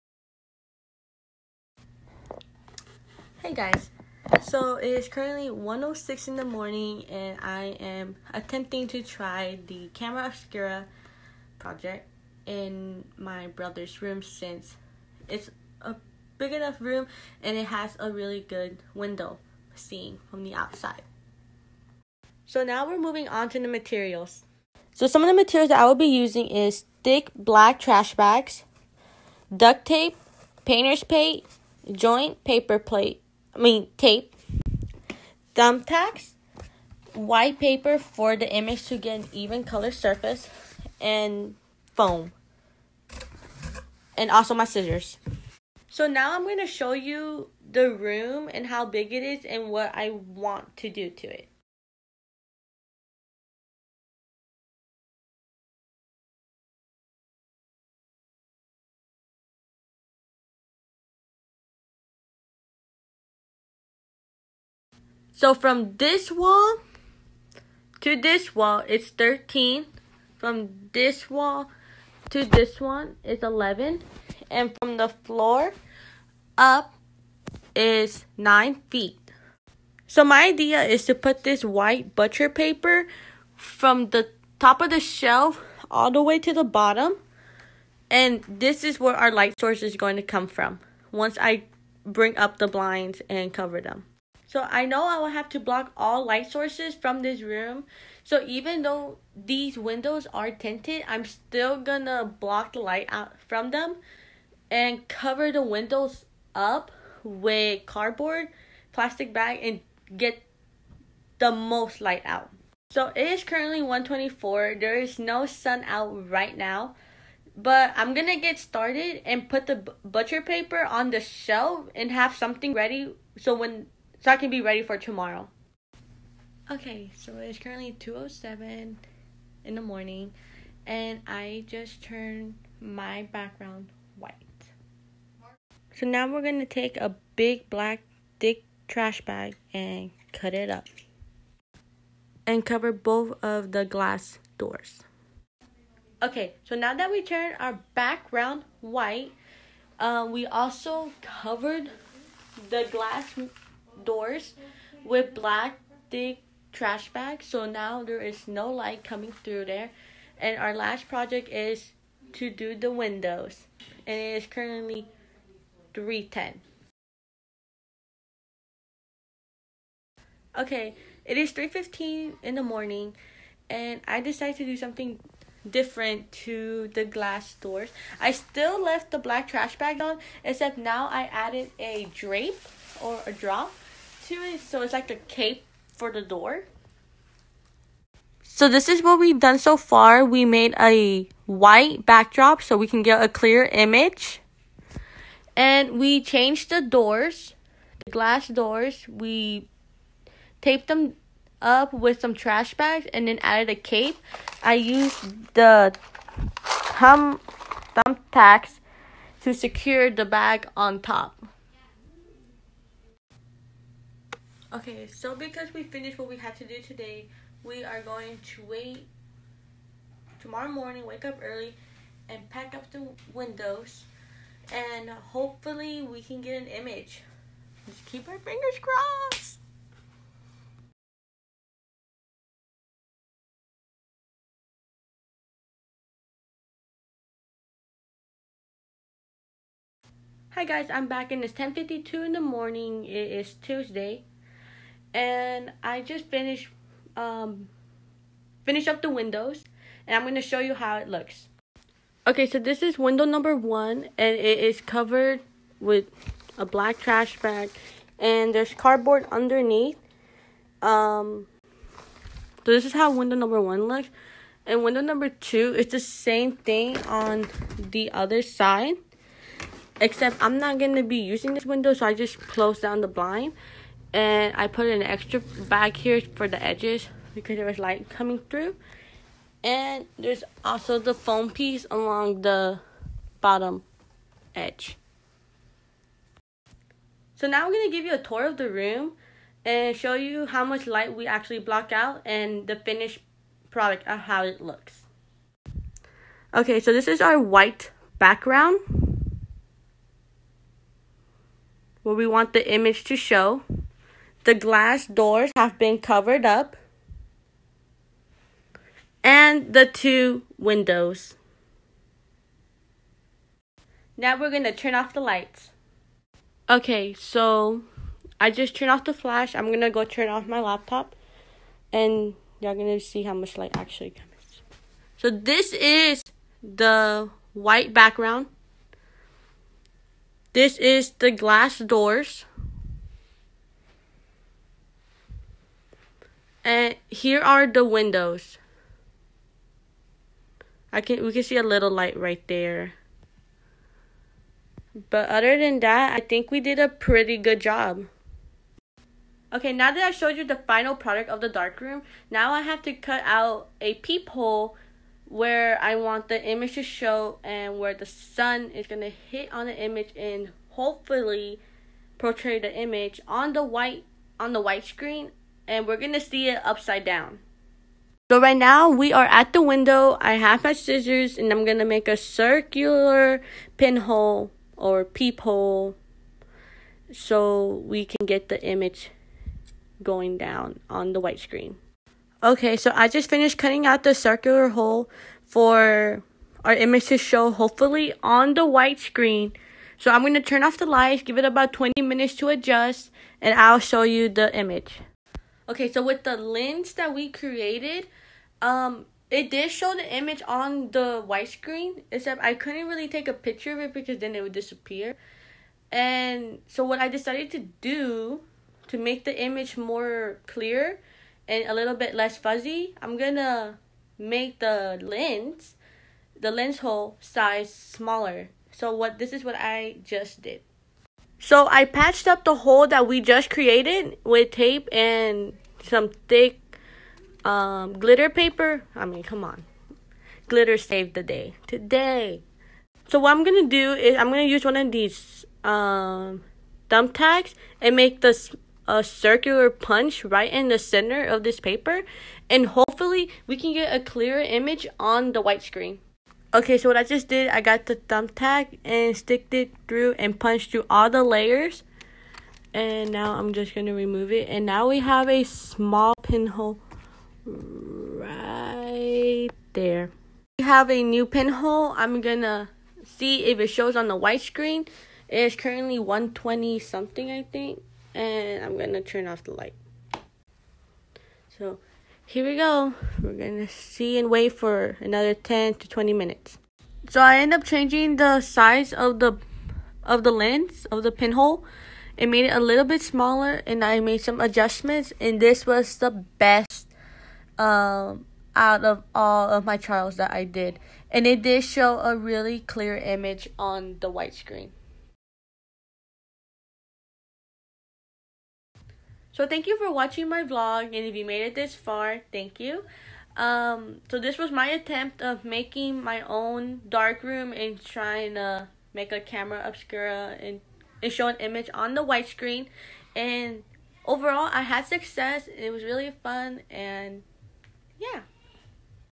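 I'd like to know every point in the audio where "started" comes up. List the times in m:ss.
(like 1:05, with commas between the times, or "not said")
1:58.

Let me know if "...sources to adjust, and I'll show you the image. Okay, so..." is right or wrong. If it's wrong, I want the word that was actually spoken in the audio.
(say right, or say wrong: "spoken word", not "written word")
wrong: "minutes", not "sources".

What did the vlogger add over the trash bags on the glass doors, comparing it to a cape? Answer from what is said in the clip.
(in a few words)
A drape.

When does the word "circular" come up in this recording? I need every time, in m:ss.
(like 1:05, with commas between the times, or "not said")
6:12, 6:24, 7:19.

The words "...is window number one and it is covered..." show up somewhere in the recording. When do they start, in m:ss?
4:12.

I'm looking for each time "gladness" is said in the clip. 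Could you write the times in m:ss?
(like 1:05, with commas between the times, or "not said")
not said.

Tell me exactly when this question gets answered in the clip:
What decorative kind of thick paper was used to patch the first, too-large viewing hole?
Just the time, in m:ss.
7:07.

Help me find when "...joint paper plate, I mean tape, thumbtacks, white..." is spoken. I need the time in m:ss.
0:31.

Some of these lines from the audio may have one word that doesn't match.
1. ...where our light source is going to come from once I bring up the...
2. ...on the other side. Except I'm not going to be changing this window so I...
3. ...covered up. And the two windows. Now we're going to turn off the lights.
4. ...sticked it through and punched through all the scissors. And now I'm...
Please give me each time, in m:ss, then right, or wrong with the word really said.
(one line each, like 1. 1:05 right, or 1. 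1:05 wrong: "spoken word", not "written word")
1. 1:28 right
2. 4:27 wrong: "using", not "changing"
3. 5:05 right
4. 7:29 wrong: "layers", not "scissors".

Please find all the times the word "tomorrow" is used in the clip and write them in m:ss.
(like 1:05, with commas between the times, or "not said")
2:04, 3:40.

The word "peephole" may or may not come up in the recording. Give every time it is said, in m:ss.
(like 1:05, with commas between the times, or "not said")
5:53, 6:15.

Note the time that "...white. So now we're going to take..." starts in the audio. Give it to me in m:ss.
2:14.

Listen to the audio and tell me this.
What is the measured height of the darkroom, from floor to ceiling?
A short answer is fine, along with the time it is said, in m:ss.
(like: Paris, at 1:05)
9 feet, at 1:18.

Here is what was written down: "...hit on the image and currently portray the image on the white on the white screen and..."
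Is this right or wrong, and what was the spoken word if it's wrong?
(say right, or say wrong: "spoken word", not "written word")
wrong: "hopefully", not "currently".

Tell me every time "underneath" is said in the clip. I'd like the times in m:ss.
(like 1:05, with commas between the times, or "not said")
4:19.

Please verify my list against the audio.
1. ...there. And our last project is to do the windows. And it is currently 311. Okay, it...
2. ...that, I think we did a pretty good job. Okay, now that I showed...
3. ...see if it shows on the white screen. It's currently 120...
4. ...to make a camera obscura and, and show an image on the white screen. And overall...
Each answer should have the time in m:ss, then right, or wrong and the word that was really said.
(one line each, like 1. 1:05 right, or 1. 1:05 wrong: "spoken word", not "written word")
1. 2:39 wrong: "310", not "311"
2. 5:45 right
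3. 7:43 right
4. 8:28 right.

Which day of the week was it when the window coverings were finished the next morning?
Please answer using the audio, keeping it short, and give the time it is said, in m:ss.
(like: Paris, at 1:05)
Tuesday, at 4:03.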